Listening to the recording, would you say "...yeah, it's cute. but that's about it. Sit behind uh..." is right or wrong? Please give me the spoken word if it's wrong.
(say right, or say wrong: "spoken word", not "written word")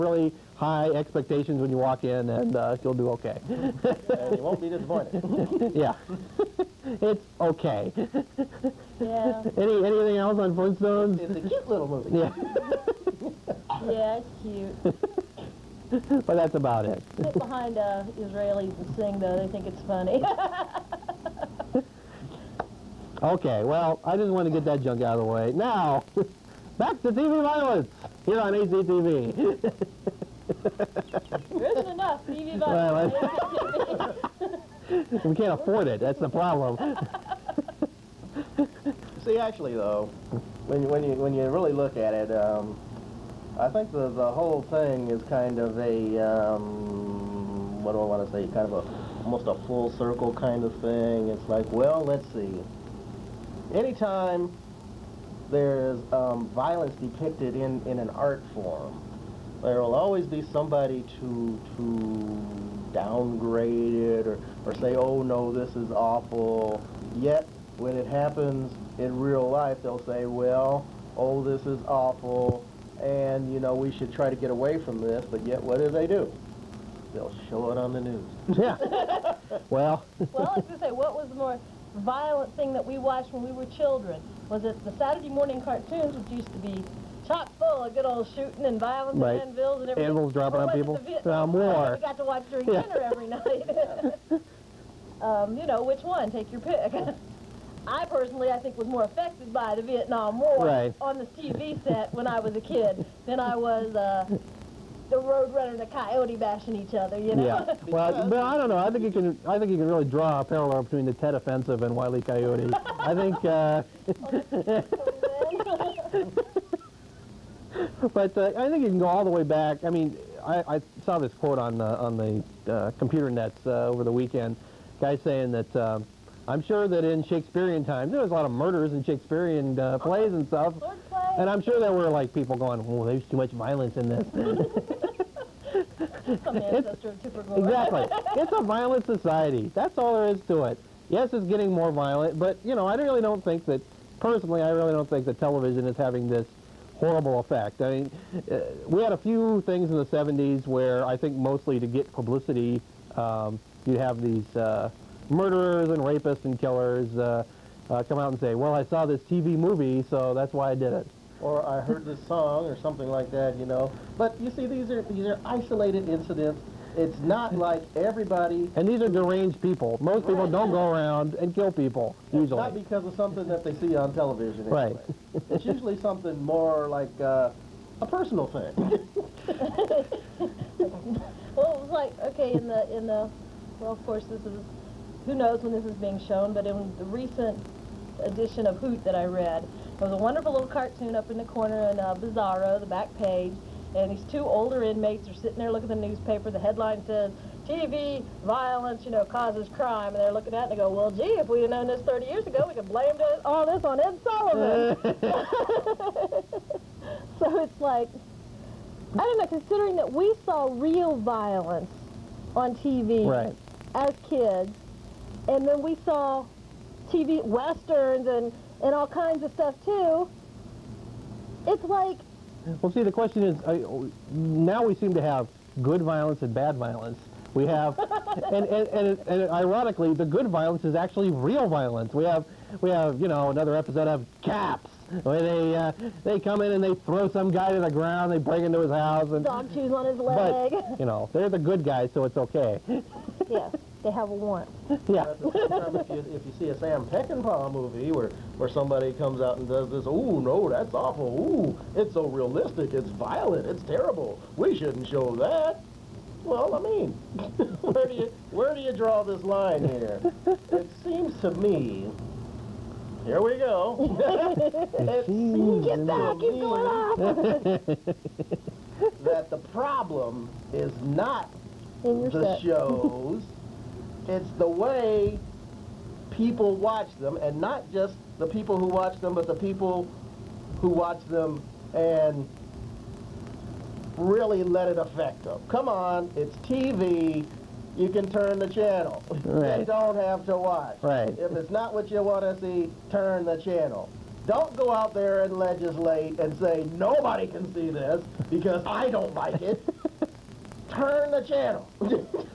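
right.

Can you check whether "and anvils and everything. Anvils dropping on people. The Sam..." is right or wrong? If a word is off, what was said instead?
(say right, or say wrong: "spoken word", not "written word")
wrong: "Vietnam", not "Sam".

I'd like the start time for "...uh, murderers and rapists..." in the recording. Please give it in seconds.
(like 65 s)
154 s.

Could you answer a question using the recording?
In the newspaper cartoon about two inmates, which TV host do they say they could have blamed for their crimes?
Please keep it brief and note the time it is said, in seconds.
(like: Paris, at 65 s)
Ed Sullivan, at 204 s.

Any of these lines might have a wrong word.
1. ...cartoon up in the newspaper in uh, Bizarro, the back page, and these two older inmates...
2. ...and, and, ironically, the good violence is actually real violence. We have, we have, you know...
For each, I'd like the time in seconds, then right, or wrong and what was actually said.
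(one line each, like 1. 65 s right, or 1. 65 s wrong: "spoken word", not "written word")
1. 190 s wrong: "corner", not "newspaper"
2. 228 s right.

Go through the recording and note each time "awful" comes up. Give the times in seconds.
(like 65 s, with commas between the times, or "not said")
65 s, 71 s, 250 s.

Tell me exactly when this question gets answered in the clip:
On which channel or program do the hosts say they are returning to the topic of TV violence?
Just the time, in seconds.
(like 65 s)
28 s.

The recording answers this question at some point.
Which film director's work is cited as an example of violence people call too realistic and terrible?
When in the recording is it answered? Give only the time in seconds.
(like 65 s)
246 s.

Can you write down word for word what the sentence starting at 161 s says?
Or I heard this song or something like that, you know.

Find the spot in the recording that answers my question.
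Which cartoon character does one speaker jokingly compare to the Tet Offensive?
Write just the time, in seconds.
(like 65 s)
111 s.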